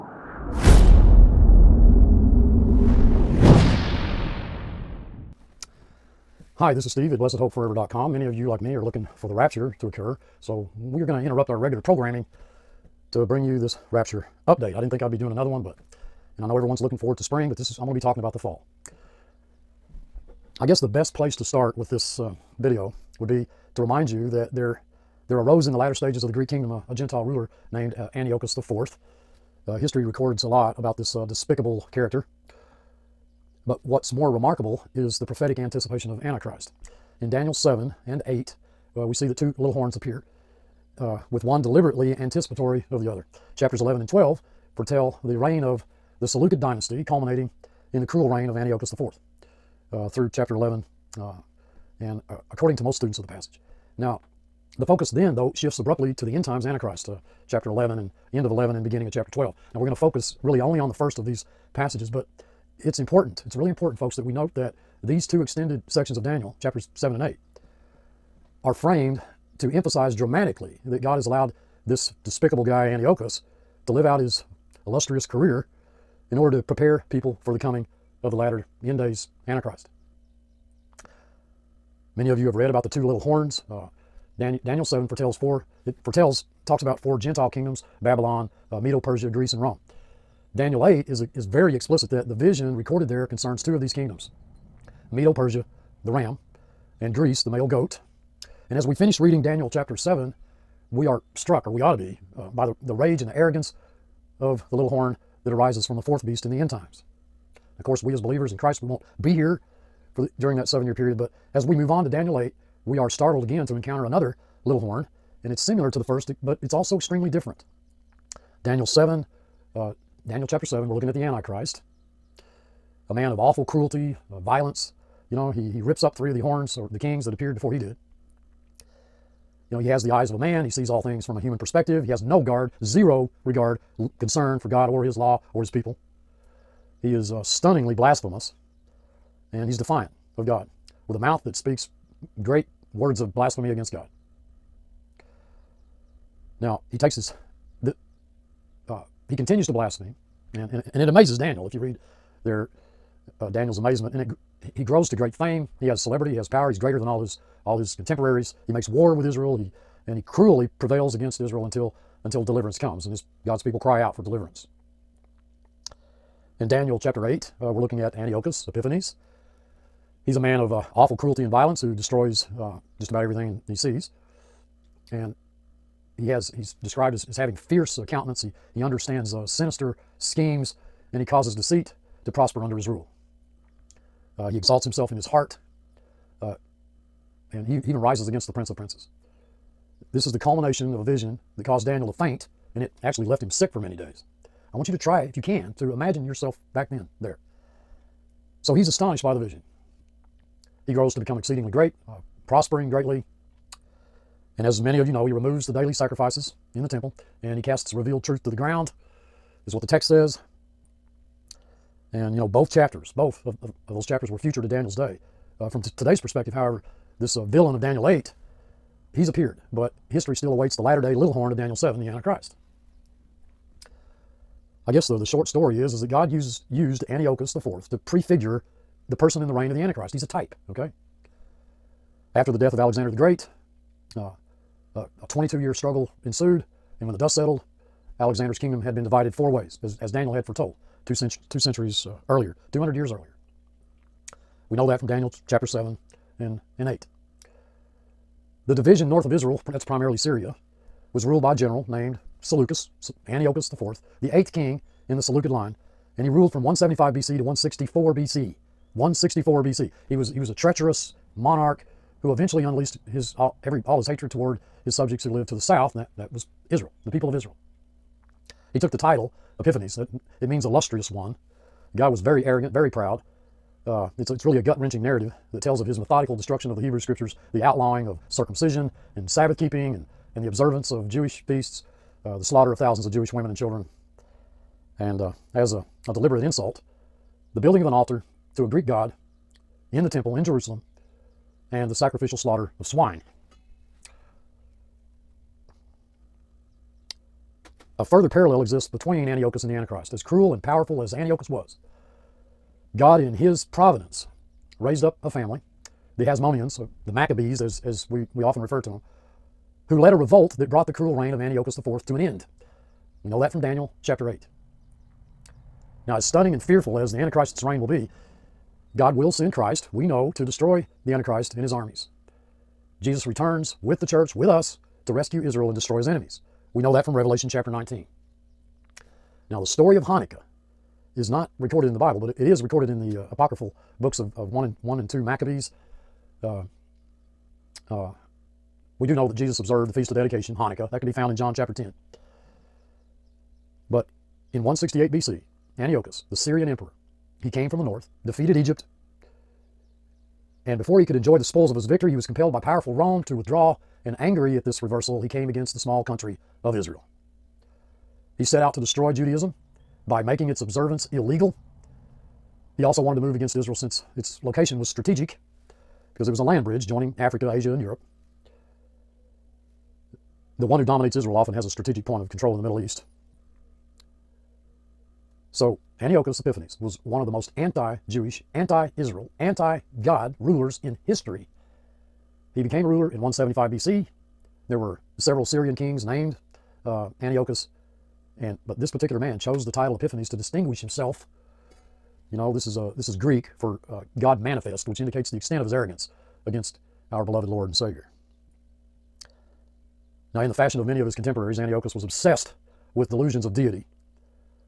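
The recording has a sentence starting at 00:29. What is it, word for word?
Uh, history records a lot about this uh, despicable character.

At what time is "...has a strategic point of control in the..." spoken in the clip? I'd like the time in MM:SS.
06:11.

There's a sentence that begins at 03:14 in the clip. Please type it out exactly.
I want you to try, if you can, to imagine yourself back then there.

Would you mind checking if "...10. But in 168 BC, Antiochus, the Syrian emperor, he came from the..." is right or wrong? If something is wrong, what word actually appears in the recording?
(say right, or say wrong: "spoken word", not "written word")
right.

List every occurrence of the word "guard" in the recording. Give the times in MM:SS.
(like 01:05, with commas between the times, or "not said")
02:12.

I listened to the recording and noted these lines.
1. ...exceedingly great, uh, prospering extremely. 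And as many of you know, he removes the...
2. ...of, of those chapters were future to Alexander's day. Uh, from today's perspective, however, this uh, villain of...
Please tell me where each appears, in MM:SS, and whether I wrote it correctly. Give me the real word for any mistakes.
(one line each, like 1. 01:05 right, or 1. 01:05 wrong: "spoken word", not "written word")
1. 03:21 wrong: "greatly", not "extremely"
2. 03:33 wrong: "Daniel", not "Alexander".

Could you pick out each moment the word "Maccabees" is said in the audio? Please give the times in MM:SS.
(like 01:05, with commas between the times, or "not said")
05:07, 05:35.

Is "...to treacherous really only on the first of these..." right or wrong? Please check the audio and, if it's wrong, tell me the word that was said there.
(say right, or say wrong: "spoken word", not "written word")
wrong: "focus", not "treacherous".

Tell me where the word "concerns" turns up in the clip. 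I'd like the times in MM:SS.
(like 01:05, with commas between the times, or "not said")
01:33, 02:14.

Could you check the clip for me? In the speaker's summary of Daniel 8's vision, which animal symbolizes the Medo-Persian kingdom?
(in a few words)
the ram.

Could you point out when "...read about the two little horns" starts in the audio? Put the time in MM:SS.
01:22.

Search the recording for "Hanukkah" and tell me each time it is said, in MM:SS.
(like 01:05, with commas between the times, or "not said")
05:30, 05:40.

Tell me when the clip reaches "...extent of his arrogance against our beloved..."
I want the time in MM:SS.
06:35.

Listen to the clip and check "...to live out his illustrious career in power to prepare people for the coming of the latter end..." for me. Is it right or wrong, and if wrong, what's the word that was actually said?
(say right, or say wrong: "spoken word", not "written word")
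wrong: "order", not "power".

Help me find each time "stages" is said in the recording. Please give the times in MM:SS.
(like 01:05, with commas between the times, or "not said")
00:25.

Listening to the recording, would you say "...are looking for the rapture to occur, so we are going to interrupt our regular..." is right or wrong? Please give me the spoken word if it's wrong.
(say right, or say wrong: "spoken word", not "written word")
right.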